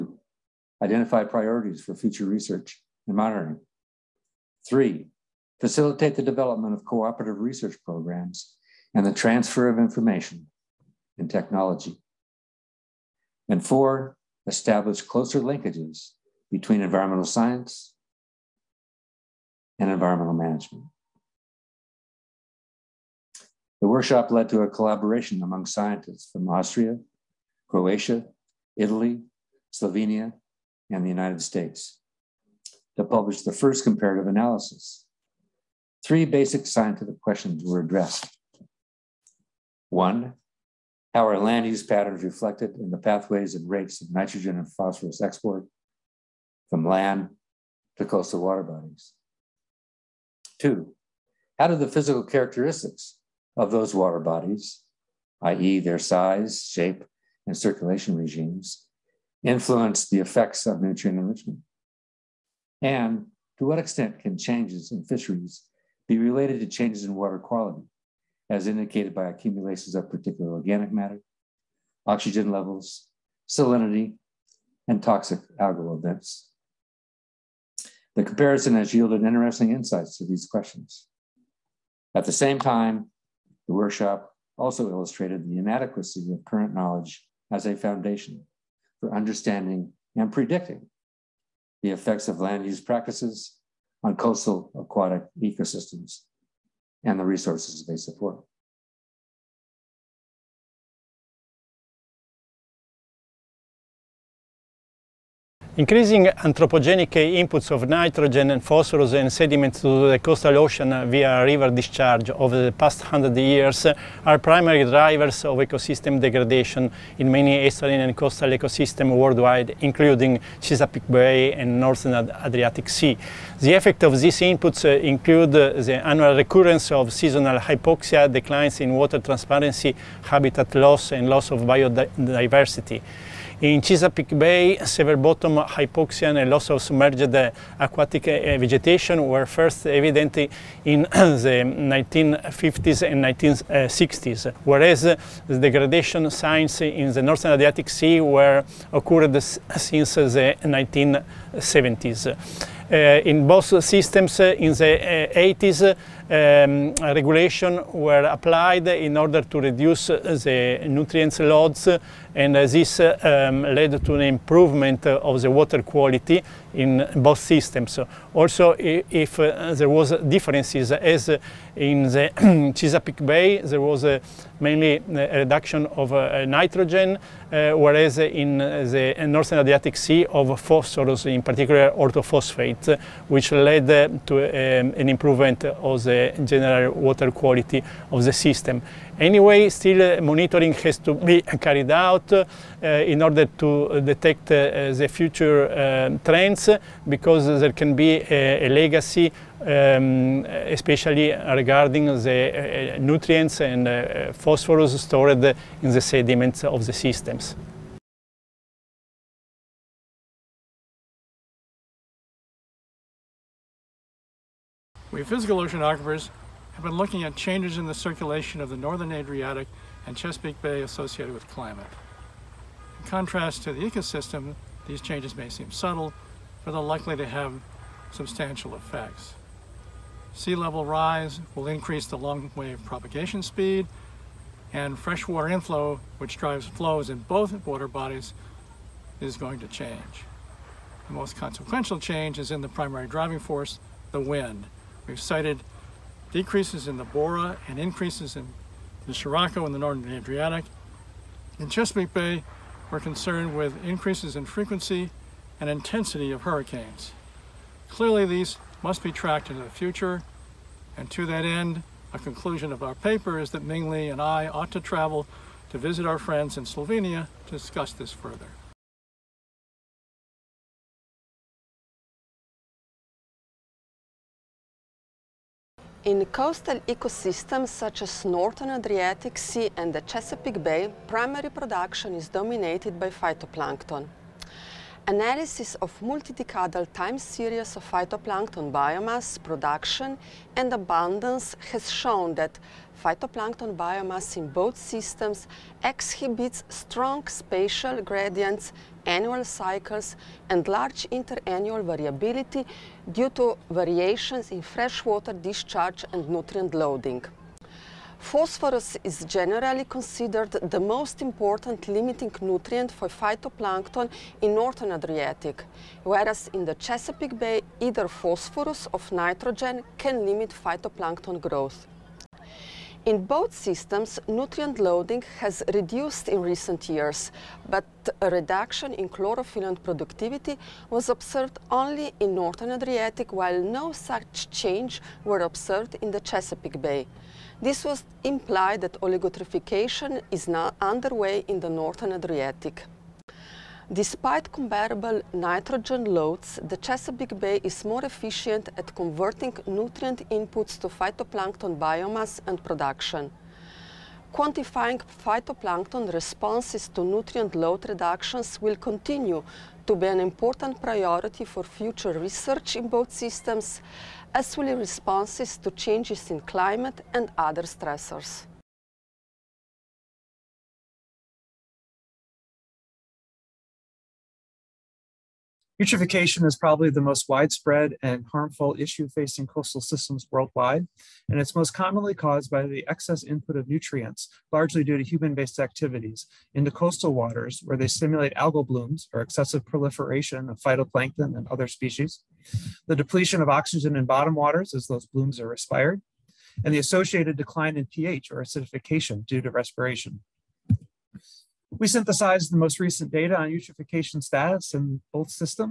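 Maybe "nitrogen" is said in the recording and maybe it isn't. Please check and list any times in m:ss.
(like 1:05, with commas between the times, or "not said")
0:44, 1:47, 2:56, 5:19, 5:45.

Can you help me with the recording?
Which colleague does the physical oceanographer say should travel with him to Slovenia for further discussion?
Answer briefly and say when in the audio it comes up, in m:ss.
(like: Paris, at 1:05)
Ming Li, at 4:23.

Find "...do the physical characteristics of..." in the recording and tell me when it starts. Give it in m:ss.
0:51.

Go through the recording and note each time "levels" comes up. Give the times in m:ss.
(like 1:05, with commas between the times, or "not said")
1:12, 3:50.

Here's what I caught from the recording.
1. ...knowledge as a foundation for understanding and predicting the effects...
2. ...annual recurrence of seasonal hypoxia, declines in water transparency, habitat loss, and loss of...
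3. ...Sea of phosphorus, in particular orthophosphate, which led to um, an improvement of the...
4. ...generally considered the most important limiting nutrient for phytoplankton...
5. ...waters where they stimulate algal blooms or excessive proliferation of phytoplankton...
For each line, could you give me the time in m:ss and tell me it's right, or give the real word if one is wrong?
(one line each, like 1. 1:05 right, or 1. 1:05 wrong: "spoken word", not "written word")
1. 1:26 right
2. 2:06 right
3. 2:59 right
4. 5:09 right
5. 6:27 right.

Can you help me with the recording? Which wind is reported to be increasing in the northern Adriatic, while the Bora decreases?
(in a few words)
Scirocco.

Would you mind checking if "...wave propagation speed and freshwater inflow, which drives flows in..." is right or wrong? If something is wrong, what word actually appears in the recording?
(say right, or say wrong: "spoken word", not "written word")
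right.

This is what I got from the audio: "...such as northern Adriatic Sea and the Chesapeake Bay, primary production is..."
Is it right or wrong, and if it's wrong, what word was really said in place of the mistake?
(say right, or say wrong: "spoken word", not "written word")
right.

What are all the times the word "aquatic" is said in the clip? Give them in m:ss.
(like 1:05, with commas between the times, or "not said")
1:34, 2:17.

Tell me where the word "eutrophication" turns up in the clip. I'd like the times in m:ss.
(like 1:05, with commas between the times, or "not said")
6:15, 6:43.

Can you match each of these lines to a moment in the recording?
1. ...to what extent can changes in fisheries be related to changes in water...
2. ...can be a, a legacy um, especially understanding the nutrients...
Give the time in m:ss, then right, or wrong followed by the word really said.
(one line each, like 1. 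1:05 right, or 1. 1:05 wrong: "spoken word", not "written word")
1. 1:03 right
2. 3:17 wrong: "regarding", not "understanding".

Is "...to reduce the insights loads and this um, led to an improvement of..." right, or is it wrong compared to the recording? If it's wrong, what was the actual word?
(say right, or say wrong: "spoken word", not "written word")
wrong: "nutrients", not "insights".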